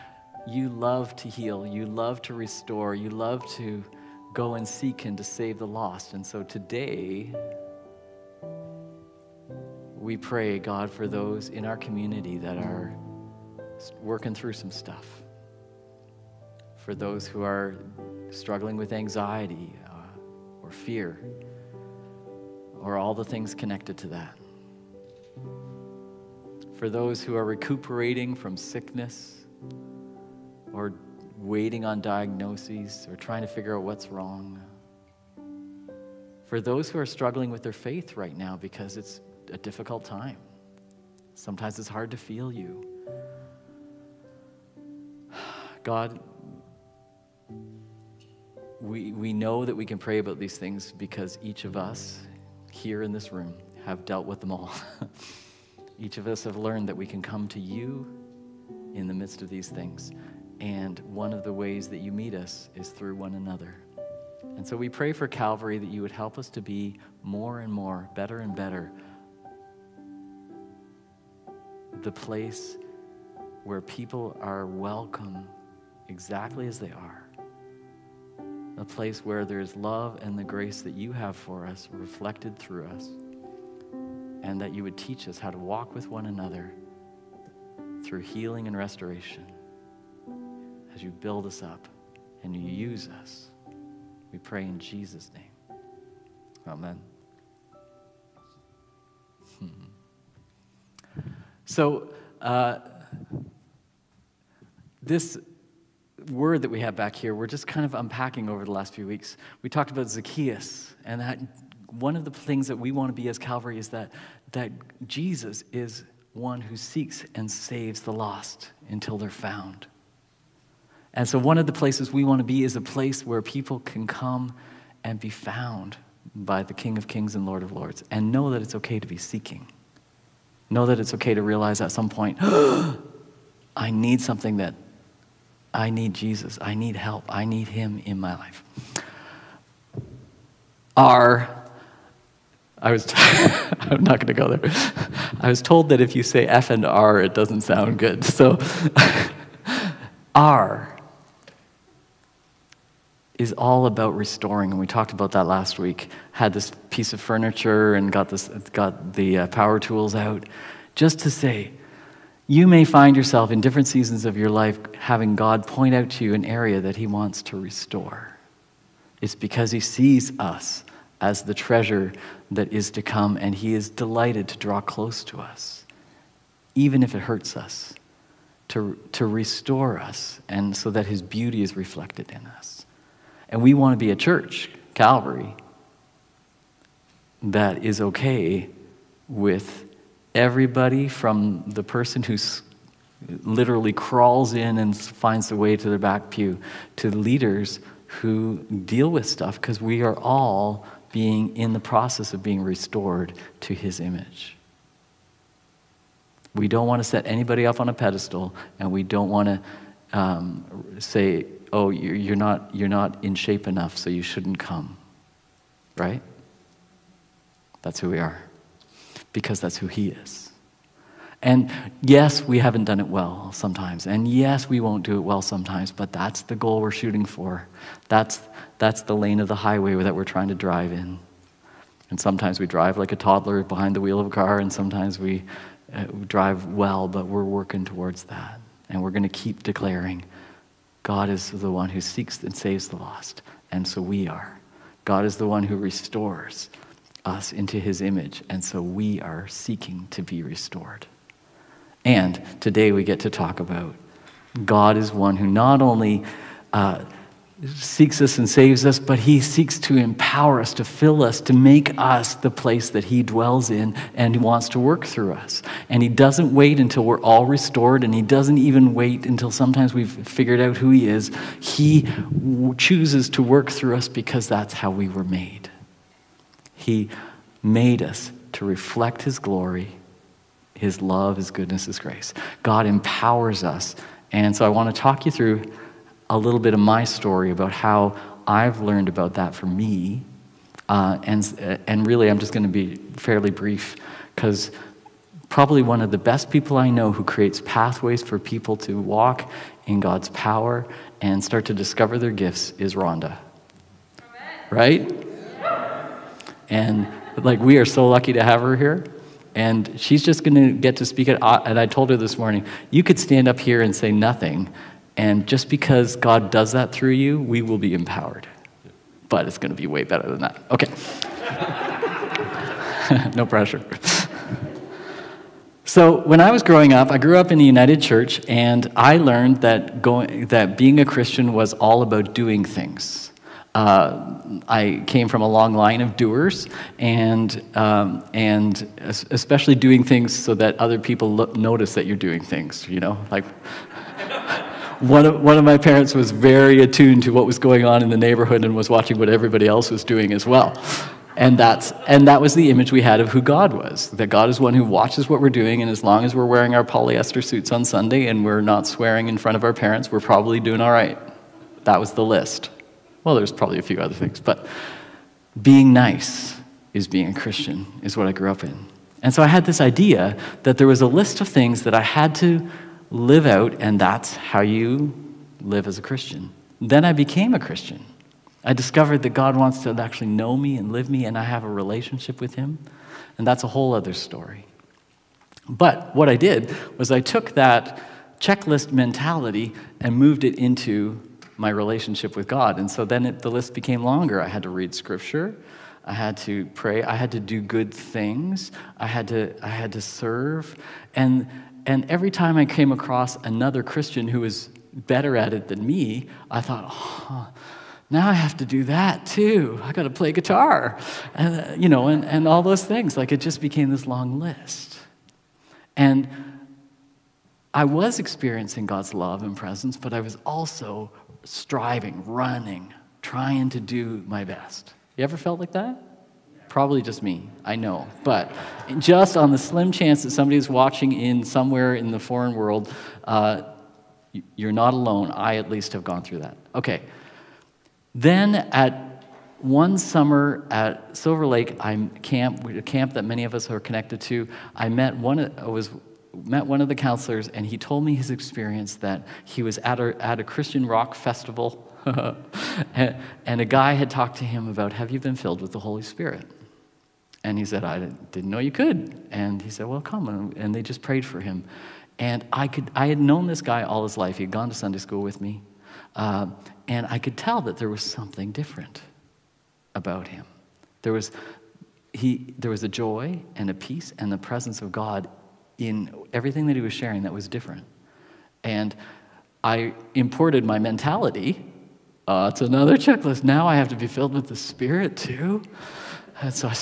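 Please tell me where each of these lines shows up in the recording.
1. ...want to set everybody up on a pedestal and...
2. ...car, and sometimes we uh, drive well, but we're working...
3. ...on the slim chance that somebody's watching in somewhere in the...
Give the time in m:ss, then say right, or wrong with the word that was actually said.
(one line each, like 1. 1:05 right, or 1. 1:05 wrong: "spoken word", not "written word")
1. 3:26 wrong: "anybody", not "everybody"
2. 3:54 right
3. 7:09 right.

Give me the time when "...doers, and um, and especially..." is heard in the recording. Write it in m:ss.
5:36.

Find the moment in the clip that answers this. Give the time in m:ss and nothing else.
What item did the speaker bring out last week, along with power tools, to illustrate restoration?
2:36.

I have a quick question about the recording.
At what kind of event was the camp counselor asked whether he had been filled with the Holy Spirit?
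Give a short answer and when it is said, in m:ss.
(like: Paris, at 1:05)
Christian rock festival, at 7:30.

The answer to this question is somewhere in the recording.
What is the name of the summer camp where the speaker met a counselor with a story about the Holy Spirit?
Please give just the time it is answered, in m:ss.
7:21.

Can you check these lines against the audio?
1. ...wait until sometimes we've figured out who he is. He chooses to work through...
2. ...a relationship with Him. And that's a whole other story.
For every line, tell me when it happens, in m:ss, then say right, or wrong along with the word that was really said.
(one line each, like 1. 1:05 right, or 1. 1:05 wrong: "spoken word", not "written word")
1. 4:28 right
2. 6:21 right.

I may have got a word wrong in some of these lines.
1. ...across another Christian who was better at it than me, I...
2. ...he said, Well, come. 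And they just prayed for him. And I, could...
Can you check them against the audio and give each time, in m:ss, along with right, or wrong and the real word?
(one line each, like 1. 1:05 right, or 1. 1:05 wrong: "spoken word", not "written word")
1. 6:42 right
2. 7:39 right.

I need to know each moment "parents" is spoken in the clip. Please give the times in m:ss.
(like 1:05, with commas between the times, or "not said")
5:45, 5:59.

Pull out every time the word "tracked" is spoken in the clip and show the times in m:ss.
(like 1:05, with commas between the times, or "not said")
not said.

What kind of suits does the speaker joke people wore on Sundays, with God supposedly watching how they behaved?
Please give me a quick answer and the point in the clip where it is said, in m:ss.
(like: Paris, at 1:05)
polyester, at 5:56.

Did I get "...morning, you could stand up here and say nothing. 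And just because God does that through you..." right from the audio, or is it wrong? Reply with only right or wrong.
right.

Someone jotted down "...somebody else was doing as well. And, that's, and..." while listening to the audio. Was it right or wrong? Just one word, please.
wrong.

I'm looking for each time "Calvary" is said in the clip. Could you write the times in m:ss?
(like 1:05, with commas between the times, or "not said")
1:05, 1:53, 3:04.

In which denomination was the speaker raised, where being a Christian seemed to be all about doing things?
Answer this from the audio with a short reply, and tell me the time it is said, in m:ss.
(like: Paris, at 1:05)
United Church, at 5:27.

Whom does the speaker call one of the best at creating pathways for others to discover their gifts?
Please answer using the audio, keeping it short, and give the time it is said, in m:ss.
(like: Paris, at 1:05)
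Rhonda, at 5:02.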